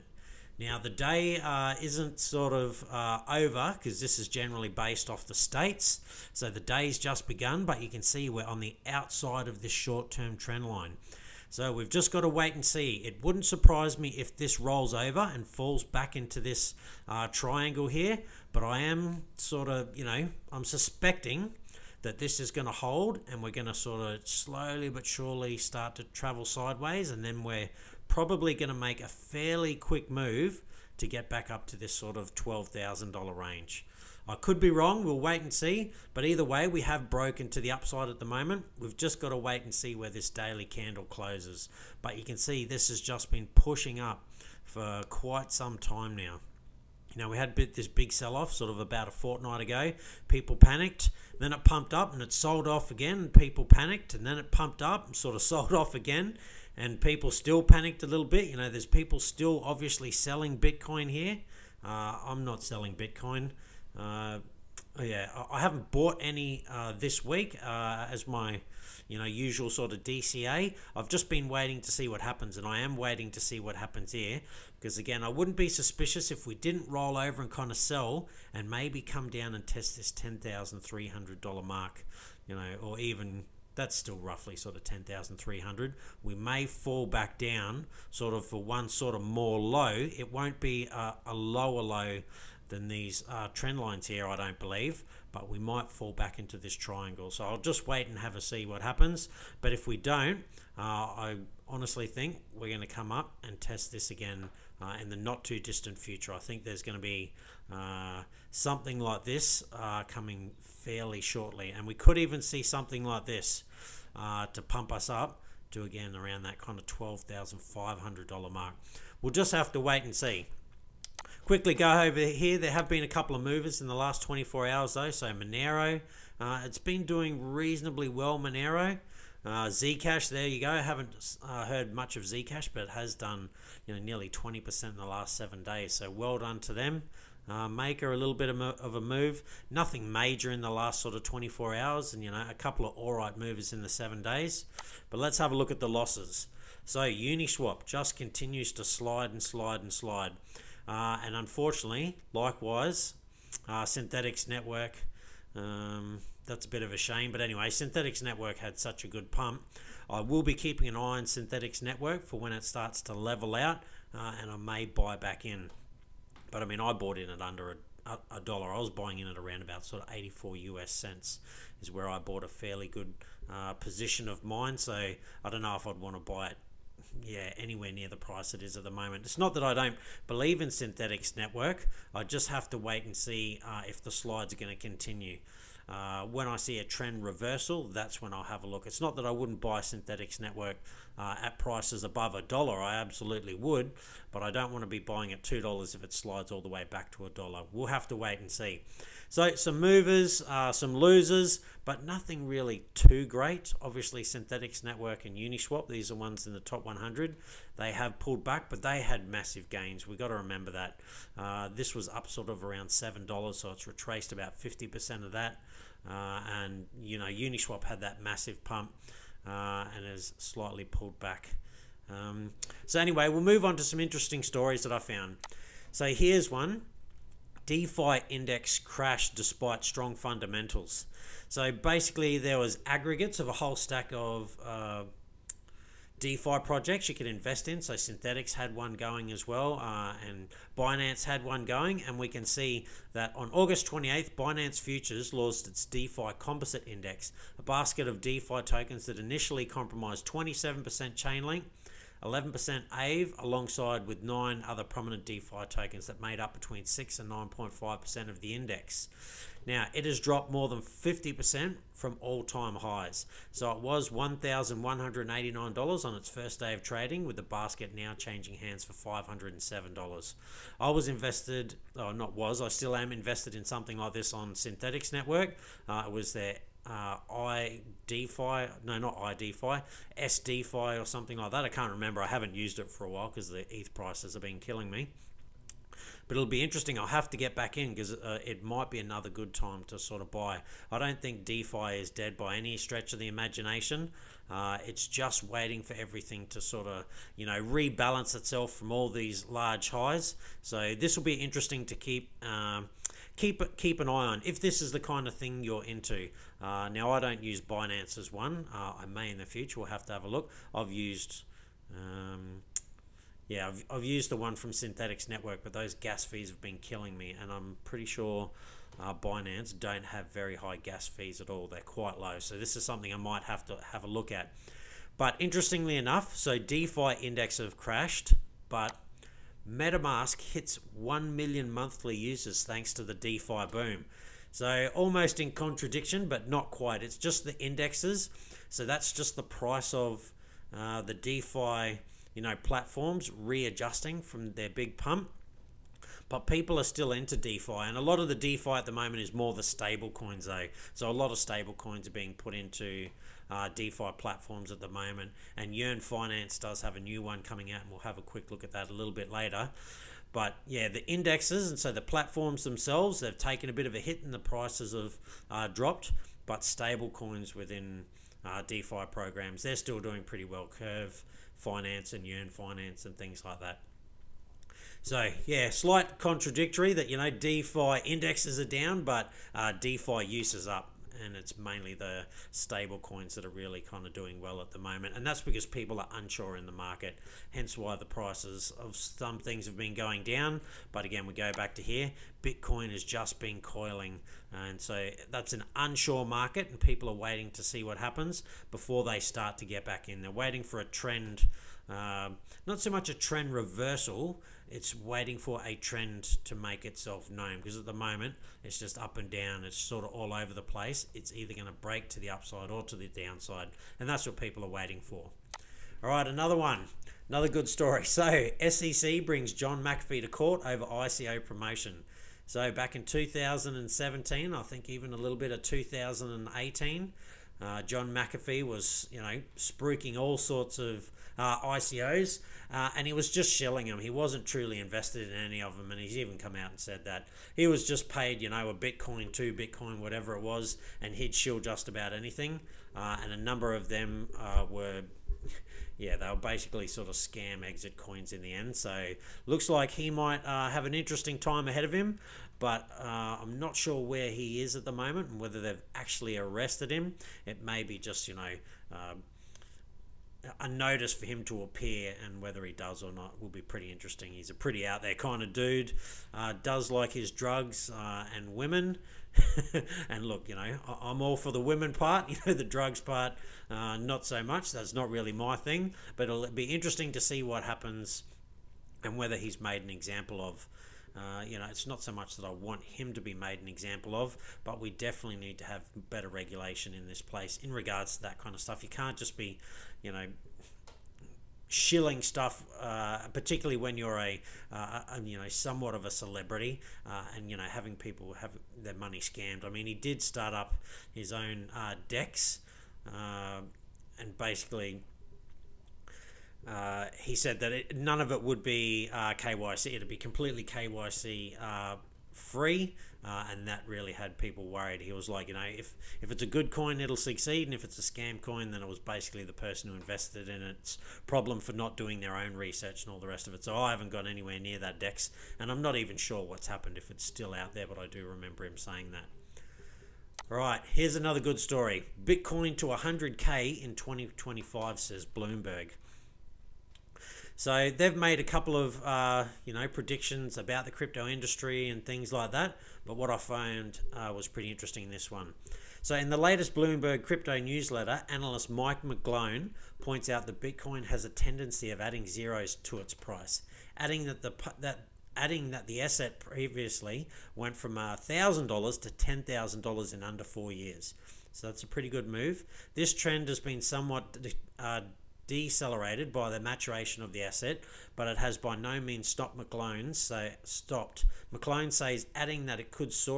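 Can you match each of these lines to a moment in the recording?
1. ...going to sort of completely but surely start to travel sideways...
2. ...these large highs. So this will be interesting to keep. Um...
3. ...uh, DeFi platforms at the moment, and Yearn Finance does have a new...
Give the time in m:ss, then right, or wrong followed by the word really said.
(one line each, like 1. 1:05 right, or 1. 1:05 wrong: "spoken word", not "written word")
1. 0:23 wrong: "slowly", not "completely"
2. 4:59 right
3. 5:53 right.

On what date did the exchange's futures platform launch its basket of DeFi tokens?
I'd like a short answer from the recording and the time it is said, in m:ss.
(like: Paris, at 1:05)
August 28th, at 4:03.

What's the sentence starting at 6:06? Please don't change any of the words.
But stable coins within uh, DeFi programs.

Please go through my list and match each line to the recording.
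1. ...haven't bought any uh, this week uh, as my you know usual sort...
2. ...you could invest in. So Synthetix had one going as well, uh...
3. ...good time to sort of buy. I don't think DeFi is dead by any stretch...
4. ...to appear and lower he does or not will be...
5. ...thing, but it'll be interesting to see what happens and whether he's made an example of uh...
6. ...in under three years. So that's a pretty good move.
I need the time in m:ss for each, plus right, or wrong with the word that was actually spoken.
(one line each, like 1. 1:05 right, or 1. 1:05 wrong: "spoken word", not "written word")
1. 1:05 right
2. 3:57 right
3. 4:49 right
4. 7:41 wrong: "whether", not "lower"
5. 7:55 right
6. 9:20 wrong: "four", not "three".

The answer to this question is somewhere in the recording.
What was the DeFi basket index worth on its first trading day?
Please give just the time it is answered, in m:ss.
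4:24.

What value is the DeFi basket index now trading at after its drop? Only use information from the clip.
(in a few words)
$507.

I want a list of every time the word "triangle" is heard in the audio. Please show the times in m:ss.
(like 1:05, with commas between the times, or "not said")
0:17, 1:36.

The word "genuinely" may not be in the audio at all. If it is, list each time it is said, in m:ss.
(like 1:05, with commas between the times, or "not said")
not said.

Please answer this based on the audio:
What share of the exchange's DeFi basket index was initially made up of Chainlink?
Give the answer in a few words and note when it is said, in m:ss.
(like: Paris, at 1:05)
27%, at 4:10.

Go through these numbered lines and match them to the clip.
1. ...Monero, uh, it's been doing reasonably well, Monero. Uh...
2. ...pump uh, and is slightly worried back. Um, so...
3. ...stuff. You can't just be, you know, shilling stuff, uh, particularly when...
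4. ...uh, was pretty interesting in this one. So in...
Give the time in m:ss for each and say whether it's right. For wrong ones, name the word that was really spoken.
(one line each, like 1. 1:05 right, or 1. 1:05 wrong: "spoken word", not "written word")
1. 2:05 right
2. 3:38 wrong: "pulled", not "worried"
3. 8:08 right
4. 9:04 right.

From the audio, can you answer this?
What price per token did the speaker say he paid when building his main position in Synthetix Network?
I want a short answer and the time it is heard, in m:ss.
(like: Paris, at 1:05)
84 US cents, at 2:50.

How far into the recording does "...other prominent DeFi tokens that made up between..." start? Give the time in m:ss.
4:14.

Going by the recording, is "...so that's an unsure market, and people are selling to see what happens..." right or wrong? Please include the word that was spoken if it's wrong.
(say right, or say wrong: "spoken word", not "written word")
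wrong: "waiting", not "selling".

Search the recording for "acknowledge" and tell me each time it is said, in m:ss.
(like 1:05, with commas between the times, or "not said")
not said.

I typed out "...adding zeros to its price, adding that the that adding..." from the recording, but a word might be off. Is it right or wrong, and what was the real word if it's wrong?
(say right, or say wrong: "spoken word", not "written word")
right.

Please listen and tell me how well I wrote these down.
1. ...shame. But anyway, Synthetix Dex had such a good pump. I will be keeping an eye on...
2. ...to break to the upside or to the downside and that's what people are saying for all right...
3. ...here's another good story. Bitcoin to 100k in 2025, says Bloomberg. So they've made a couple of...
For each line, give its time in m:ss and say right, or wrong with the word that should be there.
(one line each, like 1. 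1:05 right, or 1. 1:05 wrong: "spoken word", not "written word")
1. 2:36 wrong: "Network", not "Dex"
2. 6:51 wrong: "waiting", not "saying"
3. 8:50 right.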